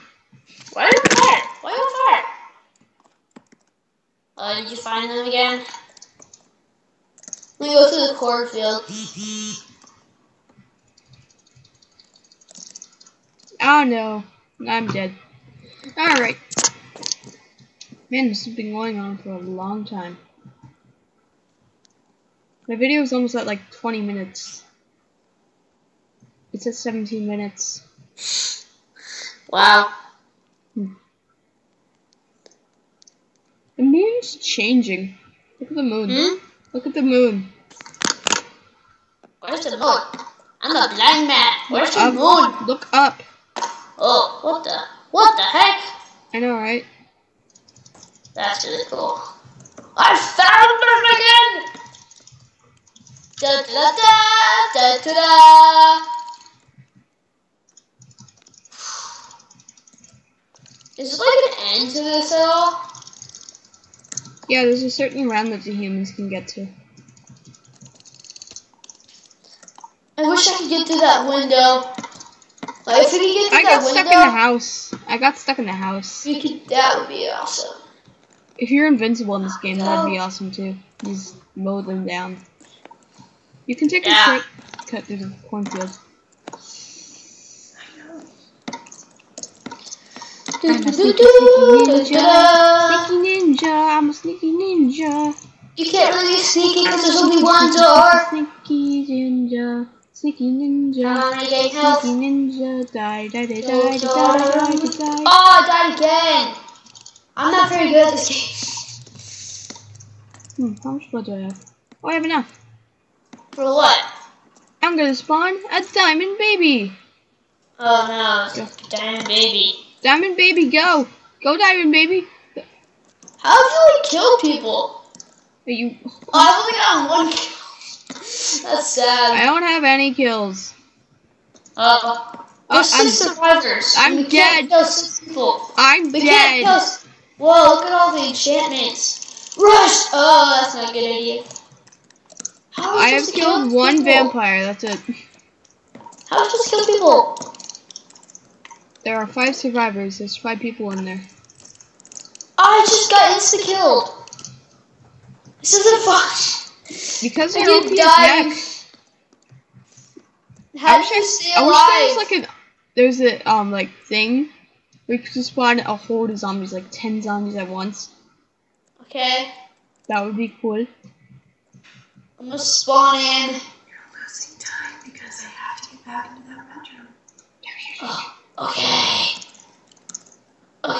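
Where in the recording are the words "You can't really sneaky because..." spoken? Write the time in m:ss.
1:35.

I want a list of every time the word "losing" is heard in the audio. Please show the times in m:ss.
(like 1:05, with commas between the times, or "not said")
2:54.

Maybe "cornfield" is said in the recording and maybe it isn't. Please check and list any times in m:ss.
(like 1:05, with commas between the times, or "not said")
0:08, 1:25.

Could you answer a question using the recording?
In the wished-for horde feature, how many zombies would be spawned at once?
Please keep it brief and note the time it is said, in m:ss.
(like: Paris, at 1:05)
10, at 2:46.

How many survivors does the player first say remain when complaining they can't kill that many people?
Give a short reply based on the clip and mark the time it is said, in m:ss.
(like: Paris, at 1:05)
6, at 2:12.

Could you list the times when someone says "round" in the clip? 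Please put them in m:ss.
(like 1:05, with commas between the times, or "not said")
1:05.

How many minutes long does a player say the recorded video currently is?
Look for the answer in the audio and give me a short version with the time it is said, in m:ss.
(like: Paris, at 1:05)
17 minutes, at 0:26.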